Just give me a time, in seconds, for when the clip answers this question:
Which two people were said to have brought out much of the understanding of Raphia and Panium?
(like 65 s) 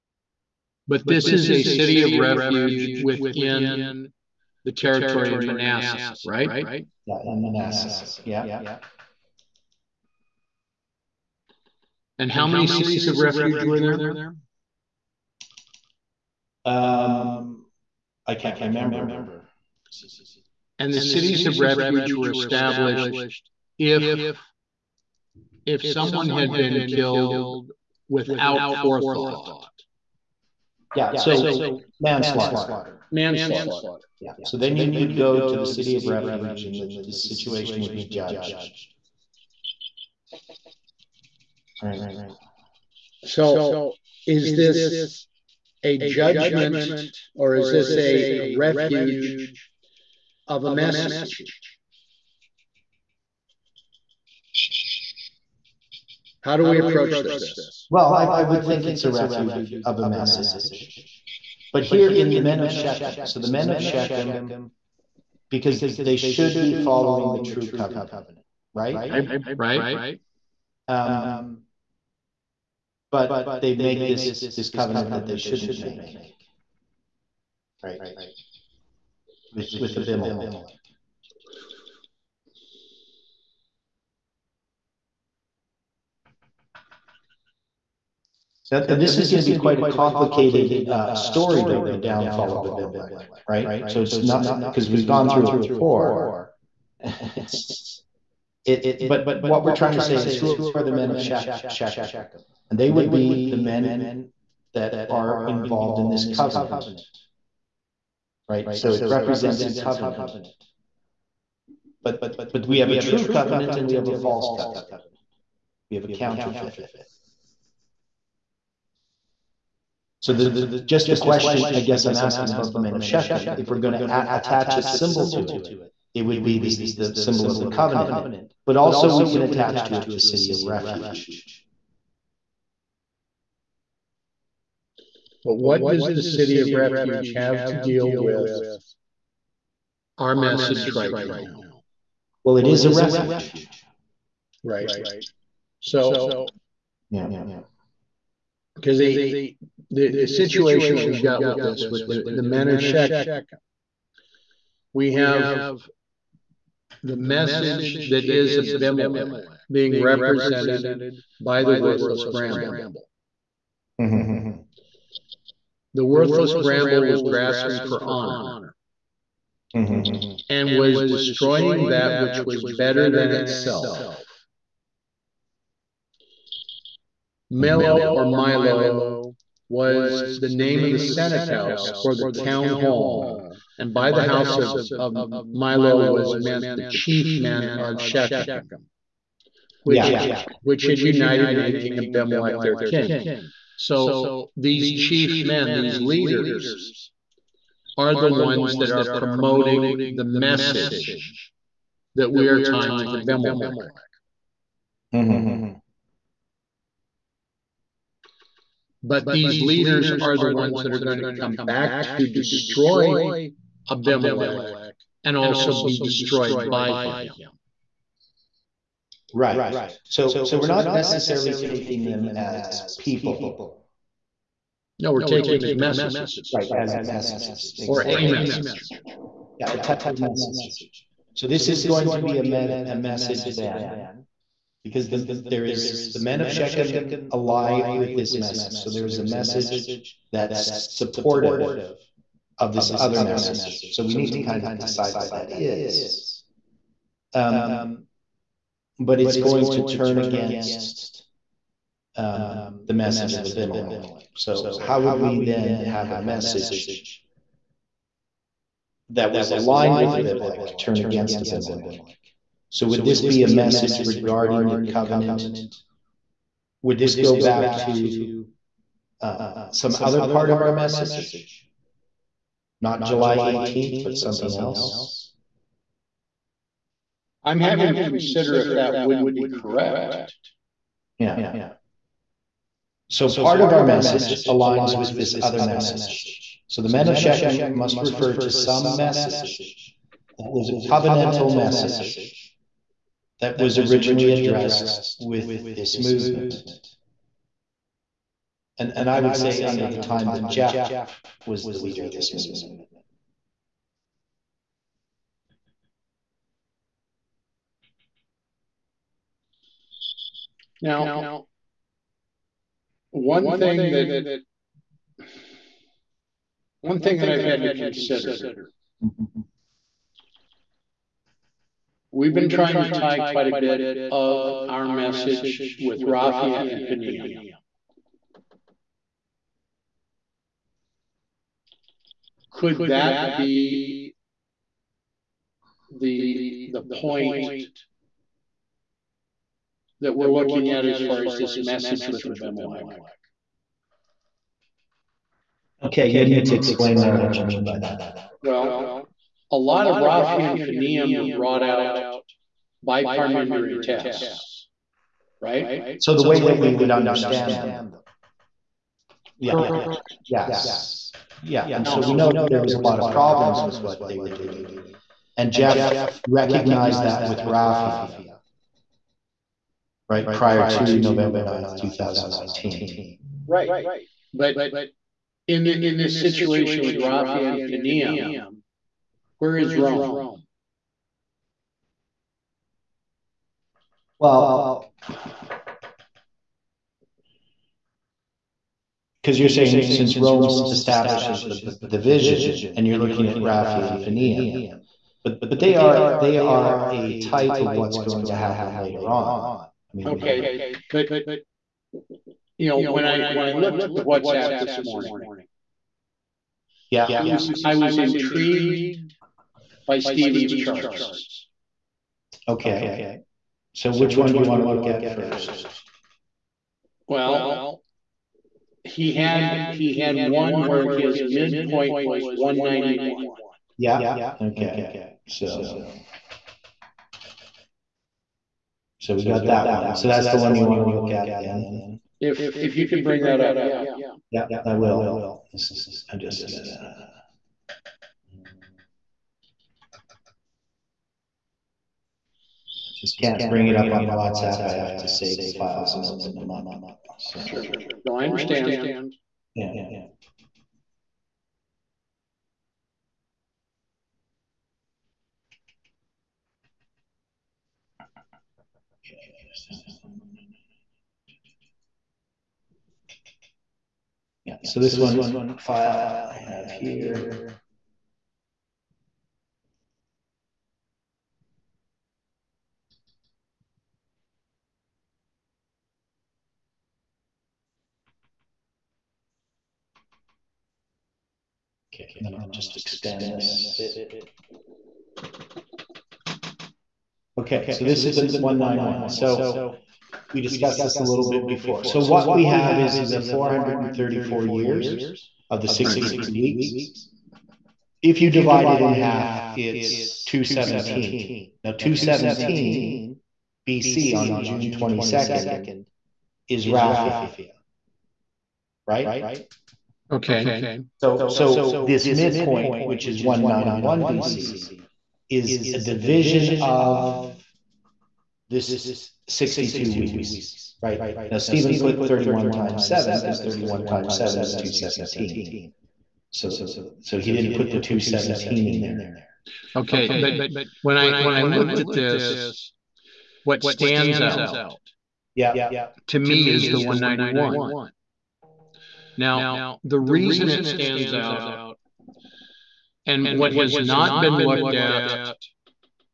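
353 s.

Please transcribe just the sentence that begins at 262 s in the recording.
So, would this be a message regarding the covenant?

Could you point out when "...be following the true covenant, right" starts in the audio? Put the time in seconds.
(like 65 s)
66 s.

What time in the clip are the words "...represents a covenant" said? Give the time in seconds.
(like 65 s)
109 s.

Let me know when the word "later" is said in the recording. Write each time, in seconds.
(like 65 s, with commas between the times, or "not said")
398 s.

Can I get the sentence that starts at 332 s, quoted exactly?
Could that be the the point that we're looking at as far as this message with Abimelech?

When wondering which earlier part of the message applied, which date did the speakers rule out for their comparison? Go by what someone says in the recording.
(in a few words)
July 18th.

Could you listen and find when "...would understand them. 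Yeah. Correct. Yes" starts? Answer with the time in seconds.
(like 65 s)
356 s.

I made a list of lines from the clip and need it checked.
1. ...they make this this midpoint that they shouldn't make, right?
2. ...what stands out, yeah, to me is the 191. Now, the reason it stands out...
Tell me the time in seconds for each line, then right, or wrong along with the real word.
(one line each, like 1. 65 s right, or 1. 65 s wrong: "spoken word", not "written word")
1. 73 s wrong: "covenant", not "midpoint"
2. 533 s right.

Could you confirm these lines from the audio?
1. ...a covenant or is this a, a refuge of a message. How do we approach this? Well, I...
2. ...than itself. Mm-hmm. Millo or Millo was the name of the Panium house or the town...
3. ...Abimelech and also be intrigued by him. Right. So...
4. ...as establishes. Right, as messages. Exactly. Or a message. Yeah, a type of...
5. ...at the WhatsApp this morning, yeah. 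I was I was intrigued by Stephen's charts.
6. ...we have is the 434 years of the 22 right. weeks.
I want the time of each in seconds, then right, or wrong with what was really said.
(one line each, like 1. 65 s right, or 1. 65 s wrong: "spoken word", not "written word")
1. 45 s wrong: "judgment", not "covenant"
2. 173 s wrong: "Senate", not "Panium"
3. 213 s wrong: "destroyed", not "intrigued"
4. 225 s wrong: "messages", not "establishes"
5. 403 s right
6. 492 s wrong: "62", not "22".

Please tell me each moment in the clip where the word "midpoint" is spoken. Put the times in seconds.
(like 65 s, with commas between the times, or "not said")
421 s, 512 s.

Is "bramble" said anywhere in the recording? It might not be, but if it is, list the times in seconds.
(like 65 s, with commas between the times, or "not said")
162 s, 166 s.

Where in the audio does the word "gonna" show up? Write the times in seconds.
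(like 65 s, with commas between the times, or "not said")
436 s.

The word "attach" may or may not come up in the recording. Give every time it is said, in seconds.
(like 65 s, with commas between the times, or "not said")
124 s, 129 s.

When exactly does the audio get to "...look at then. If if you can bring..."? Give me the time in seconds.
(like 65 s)
430 s.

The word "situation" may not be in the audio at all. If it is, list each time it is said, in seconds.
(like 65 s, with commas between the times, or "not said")
37 s, 150 s, 376 s.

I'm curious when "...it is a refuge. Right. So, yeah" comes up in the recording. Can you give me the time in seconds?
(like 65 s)
142 s.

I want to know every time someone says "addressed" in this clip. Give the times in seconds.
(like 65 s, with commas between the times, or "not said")
294 s.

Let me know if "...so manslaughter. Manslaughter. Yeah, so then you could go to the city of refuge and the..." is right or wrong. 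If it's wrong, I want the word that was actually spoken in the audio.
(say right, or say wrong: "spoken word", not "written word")
right.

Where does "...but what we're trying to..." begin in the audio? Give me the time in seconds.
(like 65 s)
98 s.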